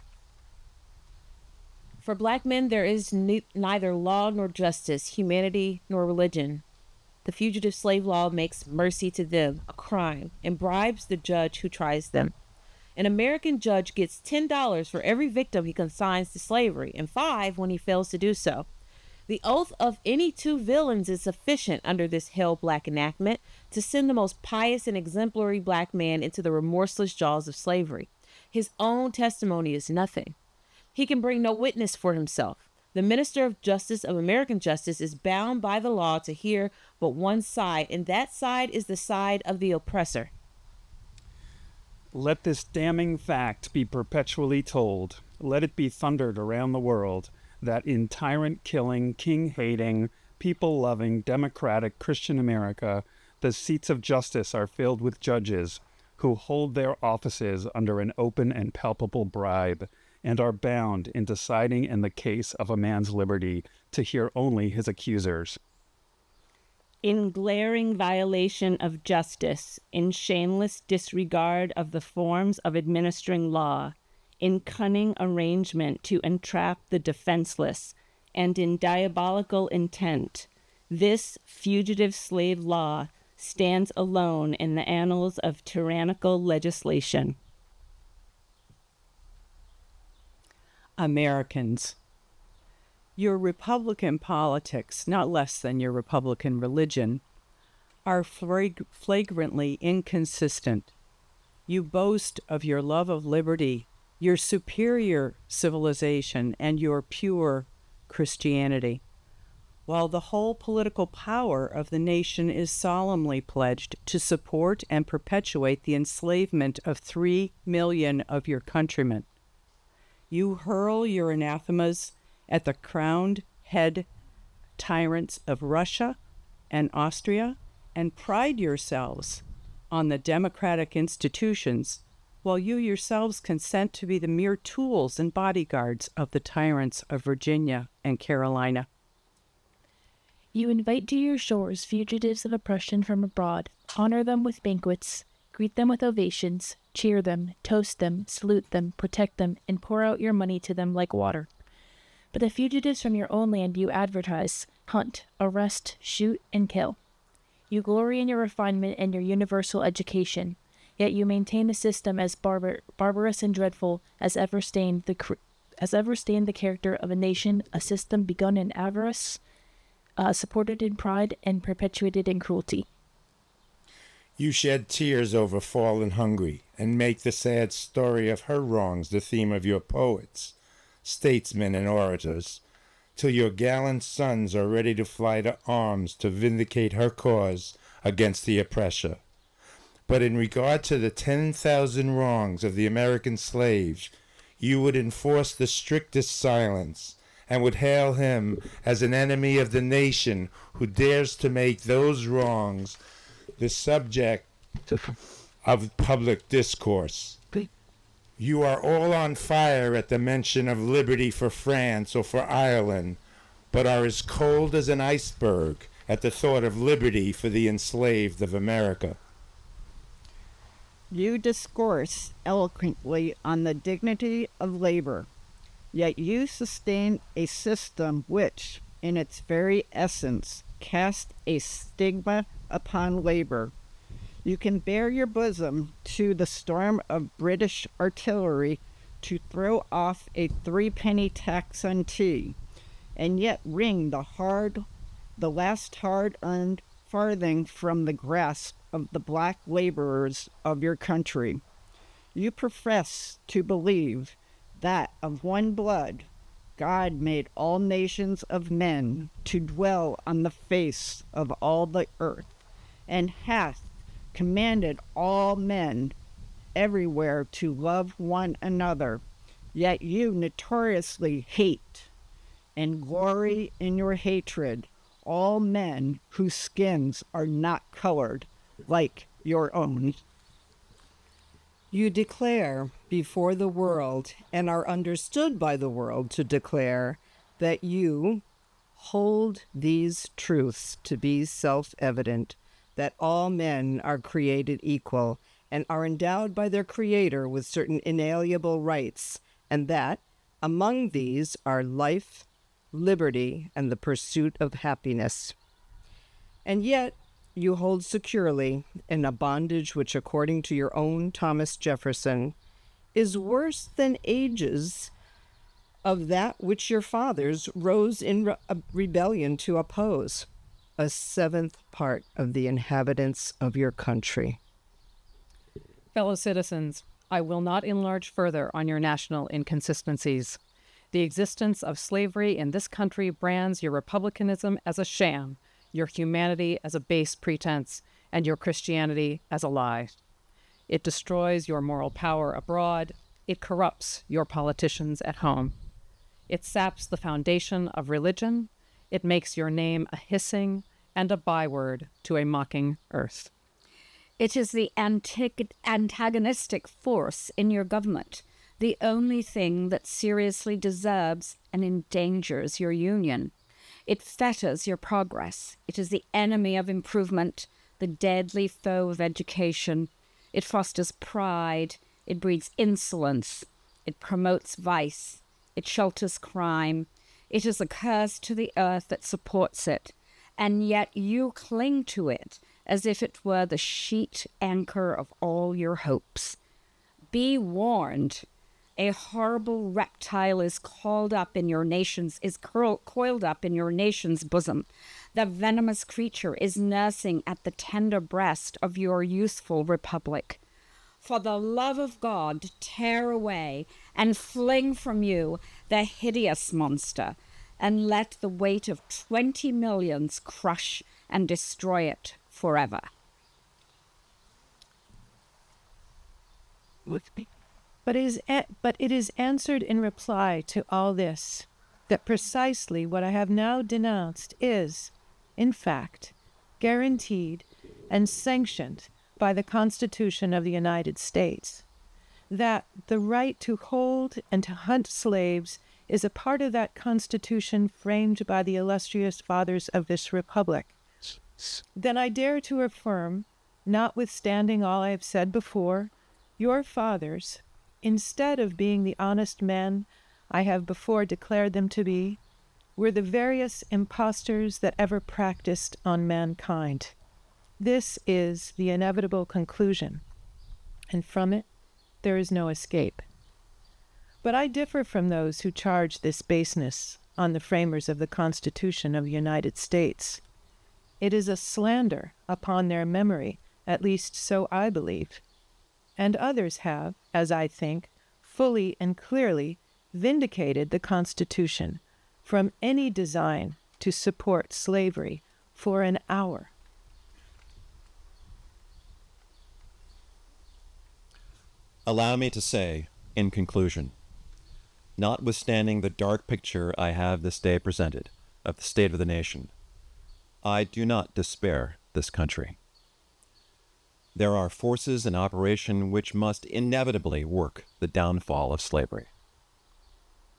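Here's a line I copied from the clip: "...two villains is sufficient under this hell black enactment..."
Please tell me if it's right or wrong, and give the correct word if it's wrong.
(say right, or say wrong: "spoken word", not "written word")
right.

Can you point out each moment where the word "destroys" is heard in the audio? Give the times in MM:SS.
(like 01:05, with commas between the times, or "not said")
05:41, 06:51.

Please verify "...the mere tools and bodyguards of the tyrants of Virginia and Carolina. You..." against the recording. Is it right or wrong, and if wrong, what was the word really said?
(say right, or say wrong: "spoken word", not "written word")
right.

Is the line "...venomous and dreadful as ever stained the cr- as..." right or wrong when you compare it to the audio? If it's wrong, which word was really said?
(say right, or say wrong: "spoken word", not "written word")
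wrong: "barbarous", not "venomous".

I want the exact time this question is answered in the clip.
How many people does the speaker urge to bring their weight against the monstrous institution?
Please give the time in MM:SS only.
06:49.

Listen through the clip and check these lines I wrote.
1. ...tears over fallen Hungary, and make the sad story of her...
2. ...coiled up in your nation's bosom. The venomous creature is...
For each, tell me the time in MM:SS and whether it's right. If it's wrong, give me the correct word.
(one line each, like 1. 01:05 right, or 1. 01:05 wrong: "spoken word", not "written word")
1. 02:54 right
2. 06:33 right.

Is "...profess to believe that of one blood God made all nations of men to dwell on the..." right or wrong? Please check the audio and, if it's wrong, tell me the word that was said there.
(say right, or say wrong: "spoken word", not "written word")
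right.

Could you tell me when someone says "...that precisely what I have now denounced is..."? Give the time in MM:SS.
07:02.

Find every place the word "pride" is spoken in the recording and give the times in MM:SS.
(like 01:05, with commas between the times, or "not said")
02:08, 02:50, 06:11.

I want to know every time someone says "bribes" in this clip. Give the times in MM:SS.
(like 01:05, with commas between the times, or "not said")
00:10, 00:59.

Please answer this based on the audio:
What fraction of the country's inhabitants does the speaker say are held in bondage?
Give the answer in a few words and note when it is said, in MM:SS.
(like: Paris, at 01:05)
A seventh part, at 05:20.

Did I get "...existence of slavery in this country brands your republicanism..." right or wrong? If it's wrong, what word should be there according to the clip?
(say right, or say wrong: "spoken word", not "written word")
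right.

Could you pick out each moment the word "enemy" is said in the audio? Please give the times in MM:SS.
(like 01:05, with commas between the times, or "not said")
03:19, 06:06.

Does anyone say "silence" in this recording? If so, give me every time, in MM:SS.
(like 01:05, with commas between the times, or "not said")
03:16.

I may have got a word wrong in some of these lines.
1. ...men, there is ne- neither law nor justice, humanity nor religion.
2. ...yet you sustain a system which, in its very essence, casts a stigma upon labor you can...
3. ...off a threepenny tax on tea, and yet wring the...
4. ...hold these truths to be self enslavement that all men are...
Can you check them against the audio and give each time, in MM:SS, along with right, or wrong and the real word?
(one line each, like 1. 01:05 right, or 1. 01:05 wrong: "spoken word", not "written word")
1. 00:02 right
2. 03:45 right
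3. 03:59 right
4. 04:48 wrong: "evident", not "enslavement".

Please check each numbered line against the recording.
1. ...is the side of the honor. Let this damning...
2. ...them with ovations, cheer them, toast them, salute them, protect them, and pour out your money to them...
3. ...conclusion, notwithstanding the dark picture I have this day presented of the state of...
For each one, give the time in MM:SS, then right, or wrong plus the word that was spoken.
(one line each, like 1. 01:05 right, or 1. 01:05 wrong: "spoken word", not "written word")
1. 00:38 wrong: "oppressor", not "honor"
2. 02:25 right
3. 08:13 right.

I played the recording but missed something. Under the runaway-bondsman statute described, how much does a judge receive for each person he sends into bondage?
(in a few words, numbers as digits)
$10.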